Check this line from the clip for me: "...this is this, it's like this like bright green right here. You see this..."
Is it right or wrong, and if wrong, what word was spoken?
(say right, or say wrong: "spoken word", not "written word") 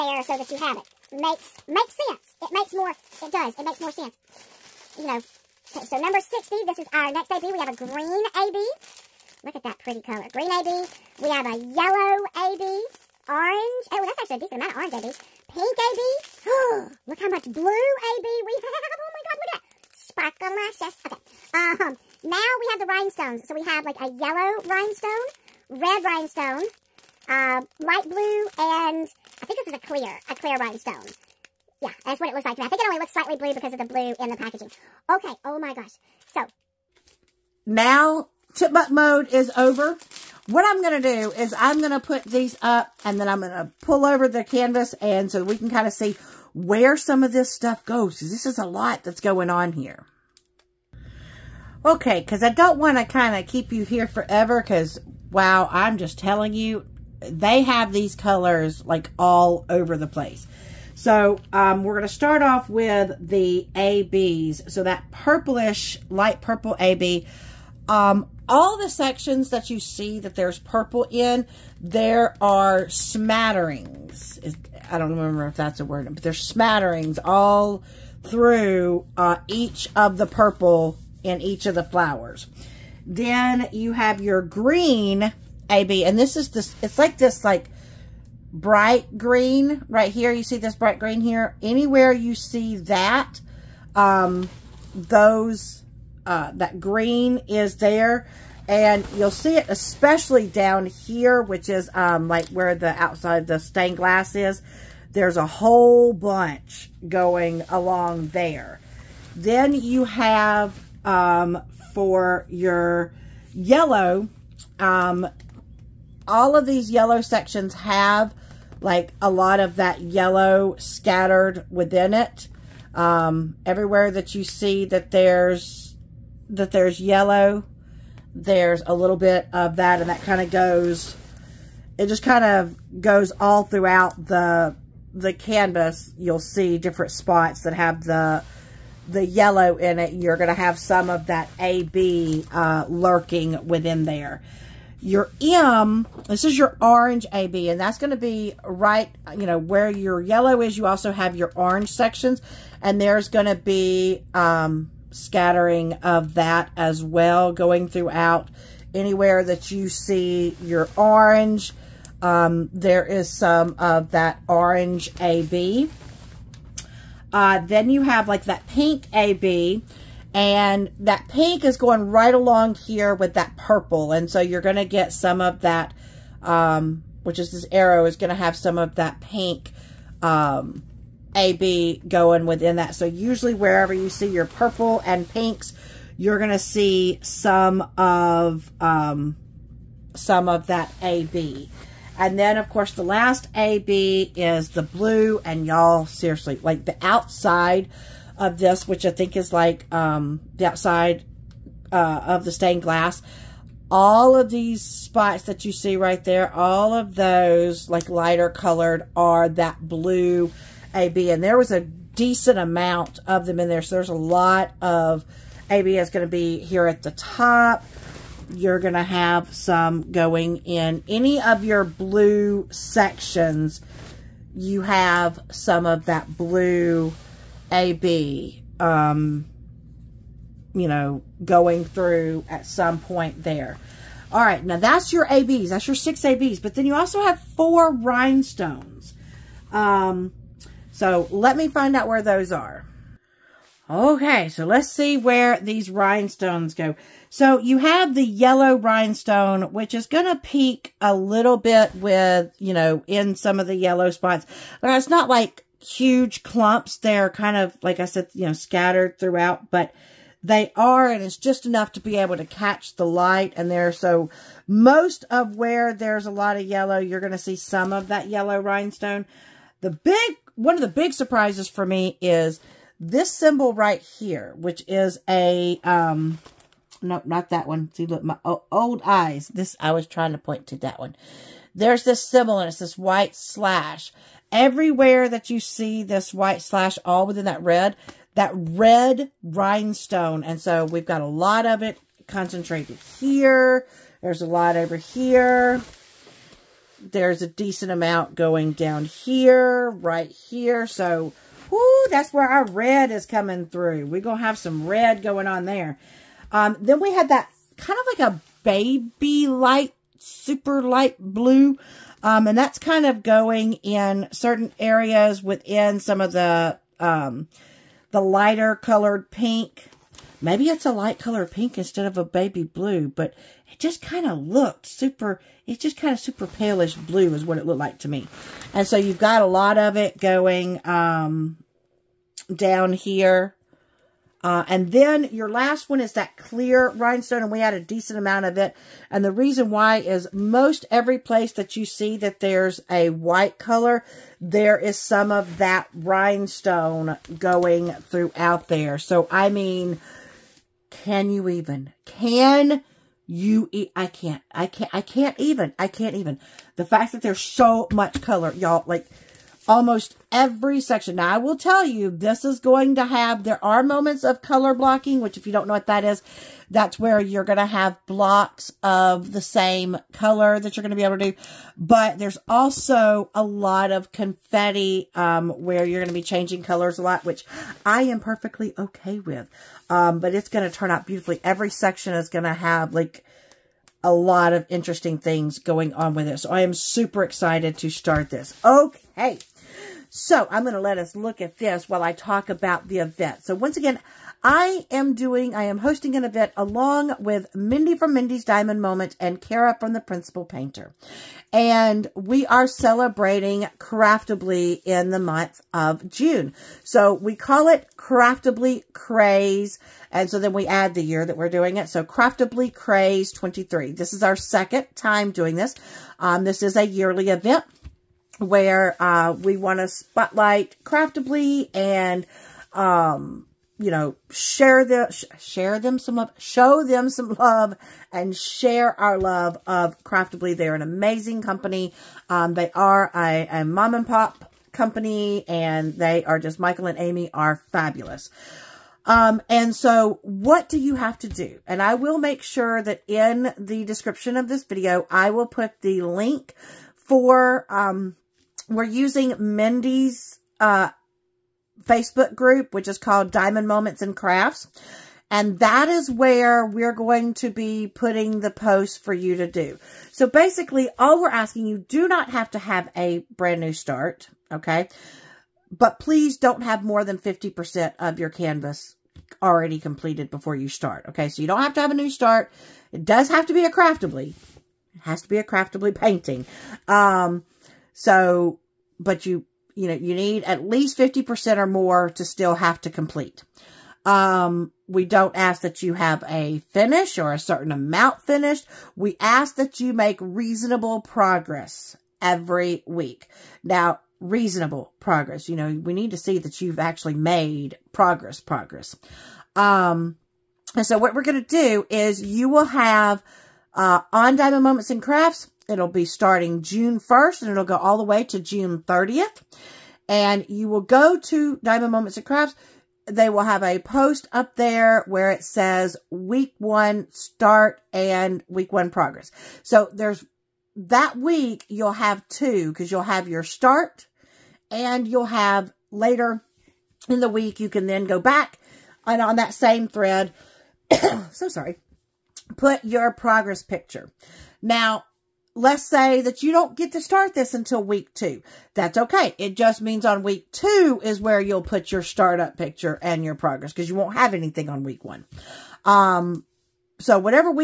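right.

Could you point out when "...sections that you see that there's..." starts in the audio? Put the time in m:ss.
1:08.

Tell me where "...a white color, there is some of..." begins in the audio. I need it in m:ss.
5:42.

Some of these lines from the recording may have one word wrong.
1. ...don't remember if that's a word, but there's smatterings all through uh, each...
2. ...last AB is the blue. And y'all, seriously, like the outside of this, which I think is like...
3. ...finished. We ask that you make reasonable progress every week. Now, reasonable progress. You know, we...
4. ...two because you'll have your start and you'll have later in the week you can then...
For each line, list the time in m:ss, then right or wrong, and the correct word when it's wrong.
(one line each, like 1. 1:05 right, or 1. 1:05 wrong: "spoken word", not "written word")
1. 1:14 right
2. 3:13 right
3. 8:08 right
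4. 8:42 right.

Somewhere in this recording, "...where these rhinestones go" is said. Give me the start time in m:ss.
4:05.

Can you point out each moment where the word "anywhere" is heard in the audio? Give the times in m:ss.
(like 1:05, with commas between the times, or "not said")
1:31, 2:38.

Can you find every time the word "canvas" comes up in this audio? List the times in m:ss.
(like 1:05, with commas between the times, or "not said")
0:44, 2:15, 7:48.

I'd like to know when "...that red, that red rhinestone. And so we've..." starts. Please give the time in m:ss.
4:47.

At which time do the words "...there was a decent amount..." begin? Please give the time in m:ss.
3:31.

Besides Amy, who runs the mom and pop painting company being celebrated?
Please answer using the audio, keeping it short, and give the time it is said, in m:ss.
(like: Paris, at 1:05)
Michael, at 7:16.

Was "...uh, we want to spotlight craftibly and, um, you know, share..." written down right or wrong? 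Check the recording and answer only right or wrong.
right.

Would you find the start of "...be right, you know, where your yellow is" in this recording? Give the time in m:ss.
2:28.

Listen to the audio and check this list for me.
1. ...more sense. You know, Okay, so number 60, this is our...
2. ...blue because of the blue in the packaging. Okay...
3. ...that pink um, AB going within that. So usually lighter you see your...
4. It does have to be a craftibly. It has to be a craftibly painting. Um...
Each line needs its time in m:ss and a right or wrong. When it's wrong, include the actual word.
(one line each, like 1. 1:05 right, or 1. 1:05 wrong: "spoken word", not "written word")
1. 0:03 right
2. 0:33 right
3. 2:58 wrong: "wherever", not "lighter"
4. 7:52 right.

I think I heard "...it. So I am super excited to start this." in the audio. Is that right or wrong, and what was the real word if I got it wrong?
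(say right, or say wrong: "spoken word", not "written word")
right.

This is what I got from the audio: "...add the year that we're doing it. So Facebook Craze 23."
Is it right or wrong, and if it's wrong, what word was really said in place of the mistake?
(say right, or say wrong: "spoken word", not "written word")
wrong: "Craftibly", not "Facebook".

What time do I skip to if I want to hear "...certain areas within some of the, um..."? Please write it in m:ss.
5:14.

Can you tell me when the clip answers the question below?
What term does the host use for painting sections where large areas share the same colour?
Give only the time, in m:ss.
6:04.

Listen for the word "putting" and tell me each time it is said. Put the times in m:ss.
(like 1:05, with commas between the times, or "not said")
7:37.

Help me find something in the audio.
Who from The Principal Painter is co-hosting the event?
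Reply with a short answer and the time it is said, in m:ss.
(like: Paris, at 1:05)
Kara, at 6:39.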